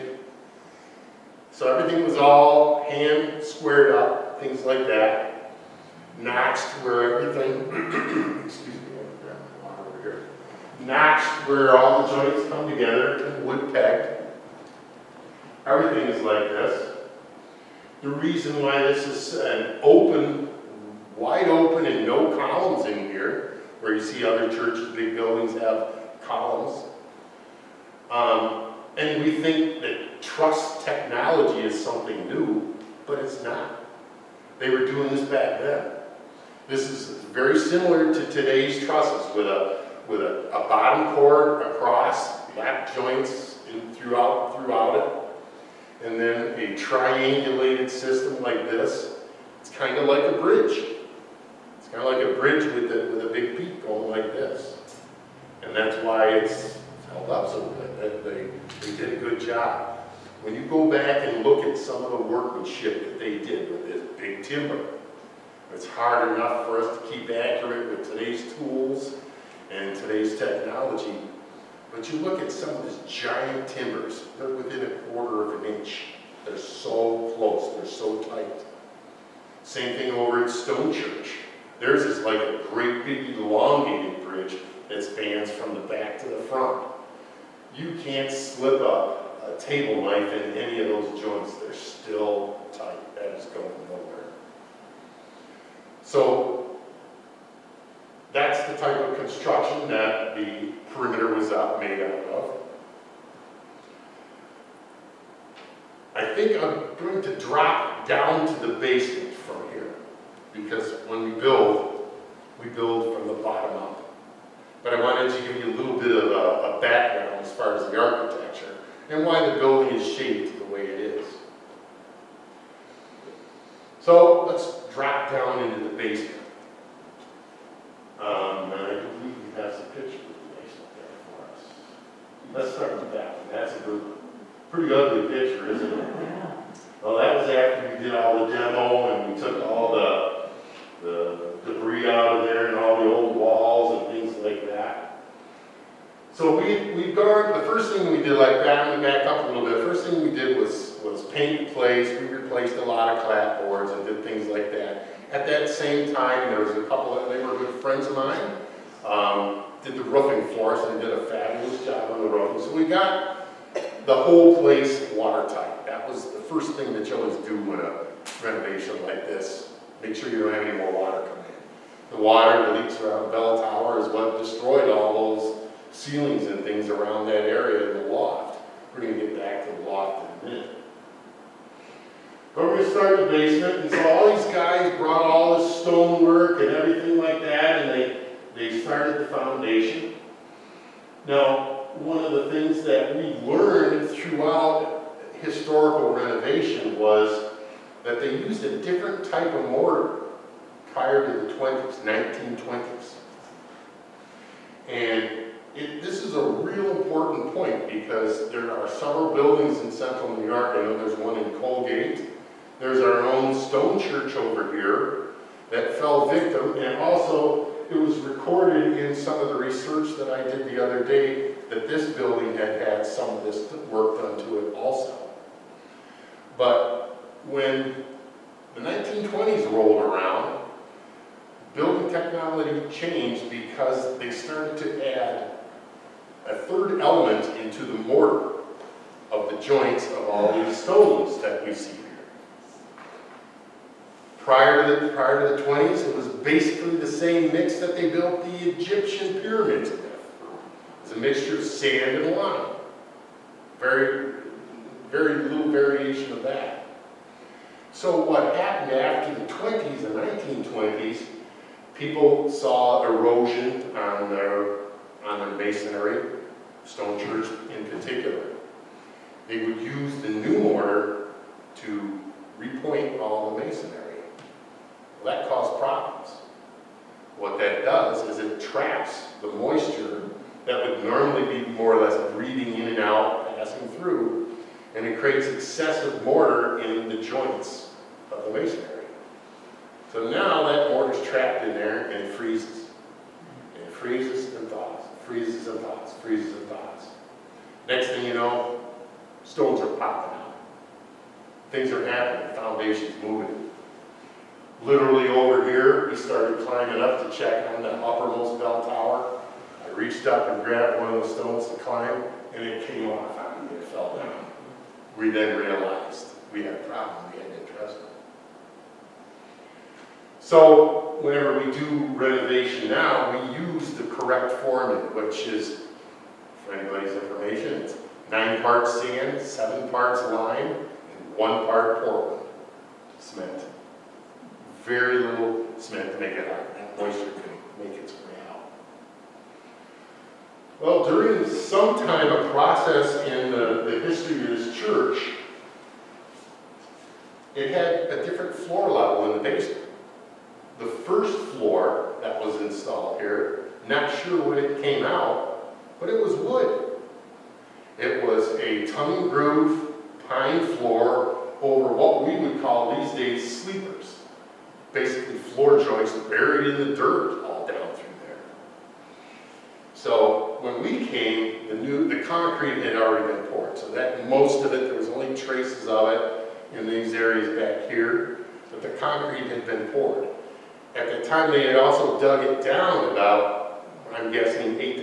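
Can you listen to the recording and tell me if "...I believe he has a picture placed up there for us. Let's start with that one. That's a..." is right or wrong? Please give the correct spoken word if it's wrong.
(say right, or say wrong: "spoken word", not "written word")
right.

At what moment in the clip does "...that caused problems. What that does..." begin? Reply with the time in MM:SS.
04:35.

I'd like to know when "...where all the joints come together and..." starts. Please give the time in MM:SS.
00:11.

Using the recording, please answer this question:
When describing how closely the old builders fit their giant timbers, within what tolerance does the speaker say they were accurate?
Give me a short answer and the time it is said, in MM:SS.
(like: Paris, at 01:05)
a quarter of an inch, at 01:14.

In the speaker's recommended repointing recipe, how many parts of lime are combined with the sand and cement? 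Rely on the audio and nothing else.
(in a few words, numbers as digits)
7.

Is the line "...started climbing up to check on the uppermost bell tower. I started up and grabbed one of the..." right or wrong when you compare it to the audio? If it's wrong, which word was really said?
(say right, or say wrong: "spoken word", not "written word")
wrong: "reached", not "started".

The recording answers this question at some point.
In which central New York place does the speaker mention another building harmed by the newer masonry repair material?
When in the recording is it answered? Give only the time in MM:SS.
03:31.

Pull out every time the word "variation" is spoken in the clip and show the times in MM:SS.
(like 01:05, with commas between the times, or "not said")
04:15.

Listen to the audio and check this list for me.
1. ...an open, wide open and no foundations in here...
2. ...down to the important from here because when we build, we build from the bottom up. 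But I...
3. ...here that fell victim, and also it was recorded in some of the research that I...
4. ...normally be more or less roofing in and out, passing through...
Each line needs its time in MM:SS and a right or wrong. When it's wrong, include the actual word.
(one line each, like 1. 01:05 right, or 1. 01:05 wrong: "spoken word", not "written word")
1. 00:19 wrong: "columns", not "foundations"
2. 01:48 wrong: "basement", not "important"
3. 03:34 right
4. 04:41 wrong: "breathing", not "roofing".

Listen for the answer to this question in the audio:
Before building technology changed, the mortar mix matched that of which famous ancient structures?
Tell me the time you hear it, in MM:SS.
04:08.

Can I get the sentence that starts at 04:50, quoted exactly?
So now that mortar is trapped in there and it freezes.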